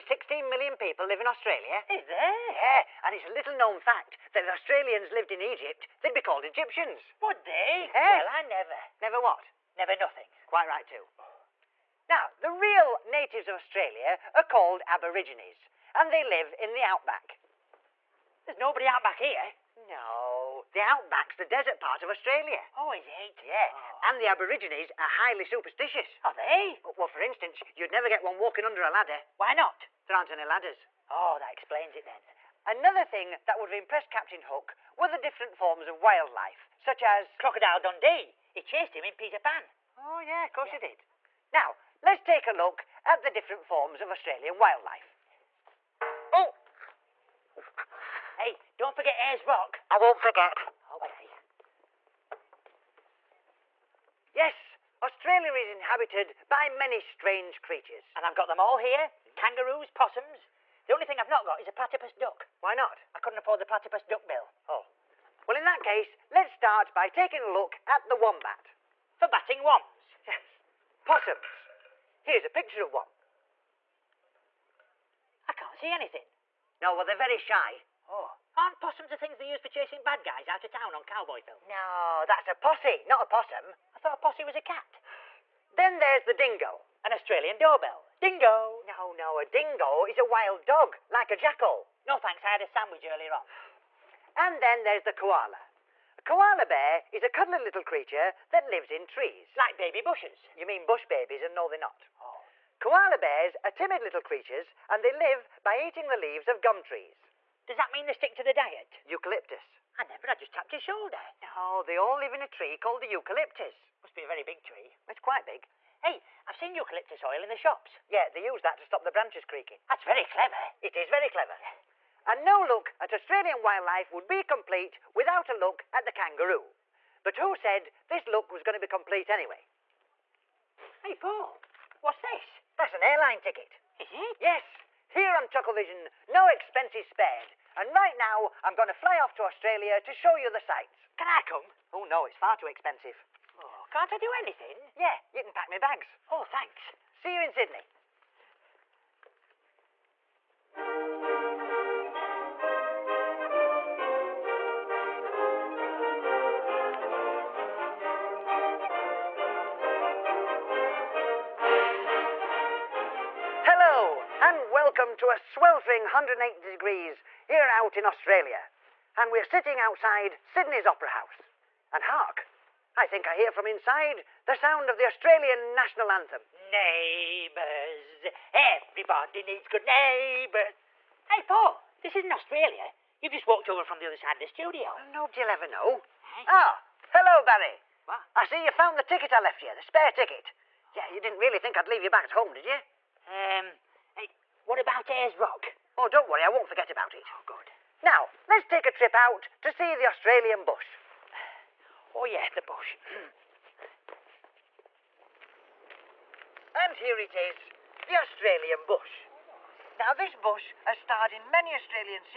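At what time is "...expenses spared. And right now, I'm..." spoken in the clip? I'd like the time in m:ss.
2:16.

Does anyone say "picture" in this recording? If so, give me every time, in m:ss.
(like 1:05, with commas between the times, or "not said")
1:12.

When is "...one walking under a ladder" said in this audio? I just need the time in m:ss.
0:28.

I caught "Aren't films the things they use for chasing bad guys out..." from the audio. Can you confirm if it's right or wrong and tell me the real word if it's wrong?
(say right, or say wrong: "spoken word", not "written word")
wrong: "possums", not "films".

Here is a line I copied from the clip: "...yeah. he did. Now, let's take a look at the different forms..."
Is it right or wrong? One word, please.
right.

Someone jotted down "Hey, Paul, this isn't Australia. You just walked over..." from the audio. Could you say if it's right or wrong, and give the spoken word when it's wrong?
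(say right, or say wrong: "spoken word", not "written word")
right.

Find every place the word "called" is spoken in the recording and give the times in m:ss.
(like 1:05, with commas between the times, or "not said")
0:06, 0:14, 1:52.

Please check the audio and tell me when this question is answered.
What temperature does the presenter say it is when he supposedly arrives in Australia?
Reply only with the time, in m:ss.
2:46.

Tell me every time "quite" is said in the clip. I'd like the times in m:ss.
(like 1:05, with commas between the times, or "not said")
0:10, 1:55.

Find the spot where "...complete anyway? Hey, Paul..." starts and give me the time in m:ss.
2:08.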